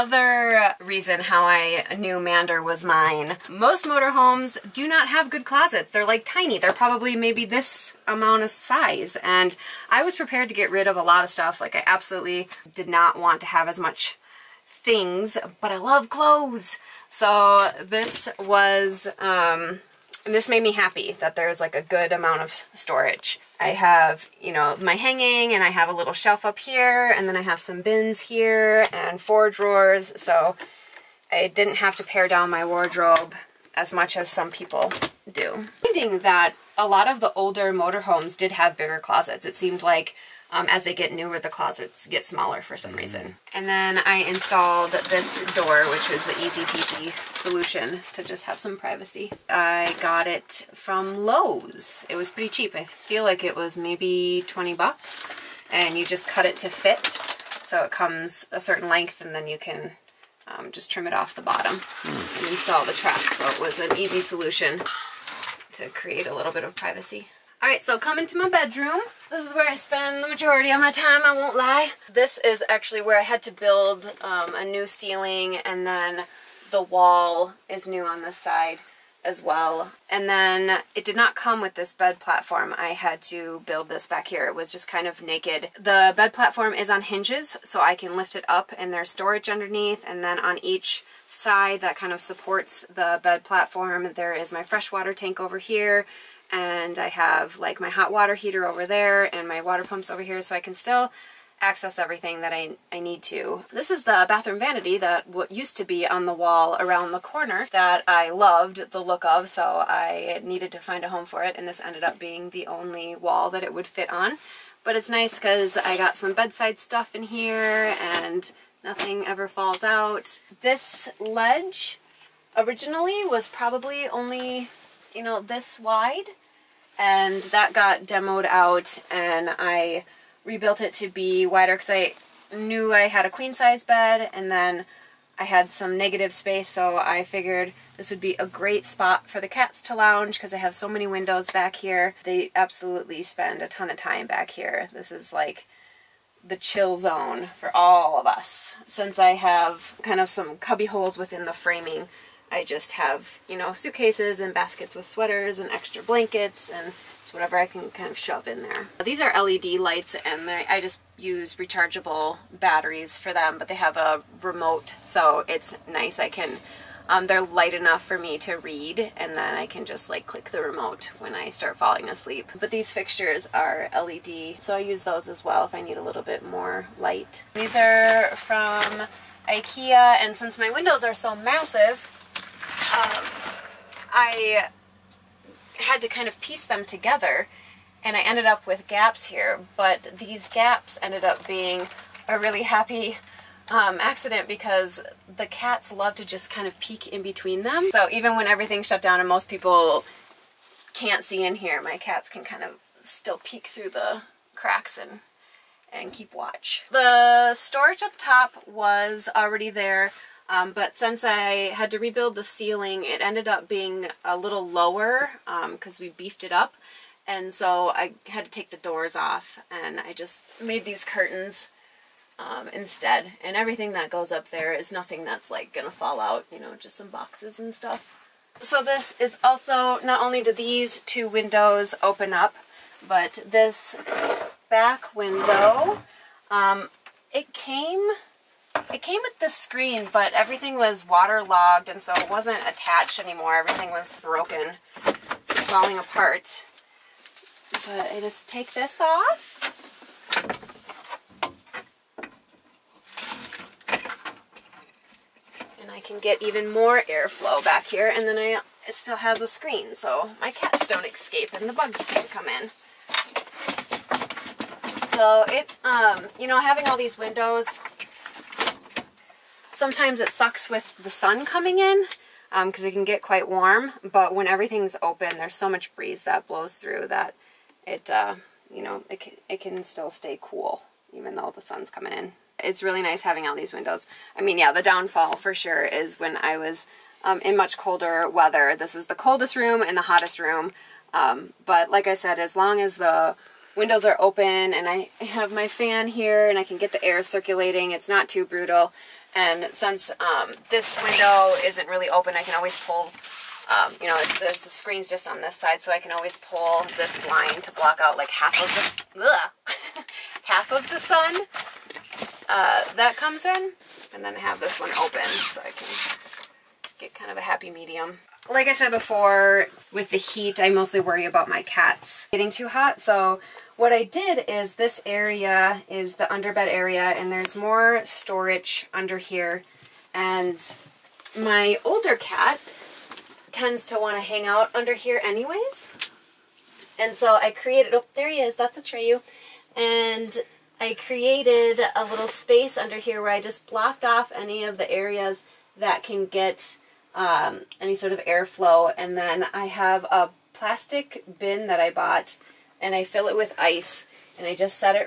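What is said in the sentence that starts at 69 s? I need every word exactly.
This is where I spend the majority of my time, I won't lie.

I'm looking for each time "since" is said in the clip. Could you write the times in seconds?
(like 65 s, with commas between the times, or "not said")
148 s, 180 s, 210 s, 299 s.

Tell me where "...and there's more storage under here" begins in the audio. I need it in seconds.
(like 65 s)
327 s.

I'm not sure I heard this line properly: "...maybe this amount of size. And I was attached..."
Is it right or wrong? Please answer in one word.
wrong.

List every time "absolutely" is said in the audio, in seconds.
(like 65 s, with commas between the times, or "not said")
11 s, 142 s.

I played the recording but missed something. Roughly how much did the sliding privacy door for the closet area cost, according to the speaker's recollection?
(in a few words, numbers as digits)
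$20.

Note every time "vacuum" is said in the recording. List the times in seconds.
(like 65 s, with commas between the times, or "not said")
not said.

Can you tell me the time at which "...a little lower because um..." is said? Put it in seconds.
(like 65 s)
214 s.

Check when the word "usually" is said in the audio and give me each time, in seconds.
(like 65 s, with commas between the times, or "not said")
not said.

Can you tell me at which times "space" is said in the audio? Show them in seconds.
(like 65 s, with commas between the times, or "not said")
136 s, 342 s.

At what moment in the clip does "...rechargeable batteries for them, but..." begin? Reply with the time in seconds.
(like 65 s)
161 s.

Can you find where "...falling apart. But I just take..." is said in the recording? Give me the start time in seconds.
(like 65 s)
245 s.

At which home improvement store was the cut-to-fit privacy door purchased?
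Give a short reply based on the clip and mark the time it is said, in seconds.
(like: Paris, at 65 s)
Lowe's, at 51 s.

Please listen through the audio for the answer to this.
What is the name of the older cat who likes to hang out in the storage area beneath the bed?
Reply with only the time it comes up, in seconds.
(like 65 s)
338 s.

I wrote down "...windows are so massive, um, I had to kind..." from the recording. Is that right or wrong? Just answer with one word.
right.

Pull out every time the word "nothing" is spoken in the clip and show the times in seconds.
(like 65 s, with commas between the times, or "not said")
118 s, 224 s.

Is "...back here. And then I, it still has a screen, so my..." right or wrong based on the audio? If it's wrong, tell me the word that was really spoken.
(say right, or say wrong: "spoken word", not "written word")
right.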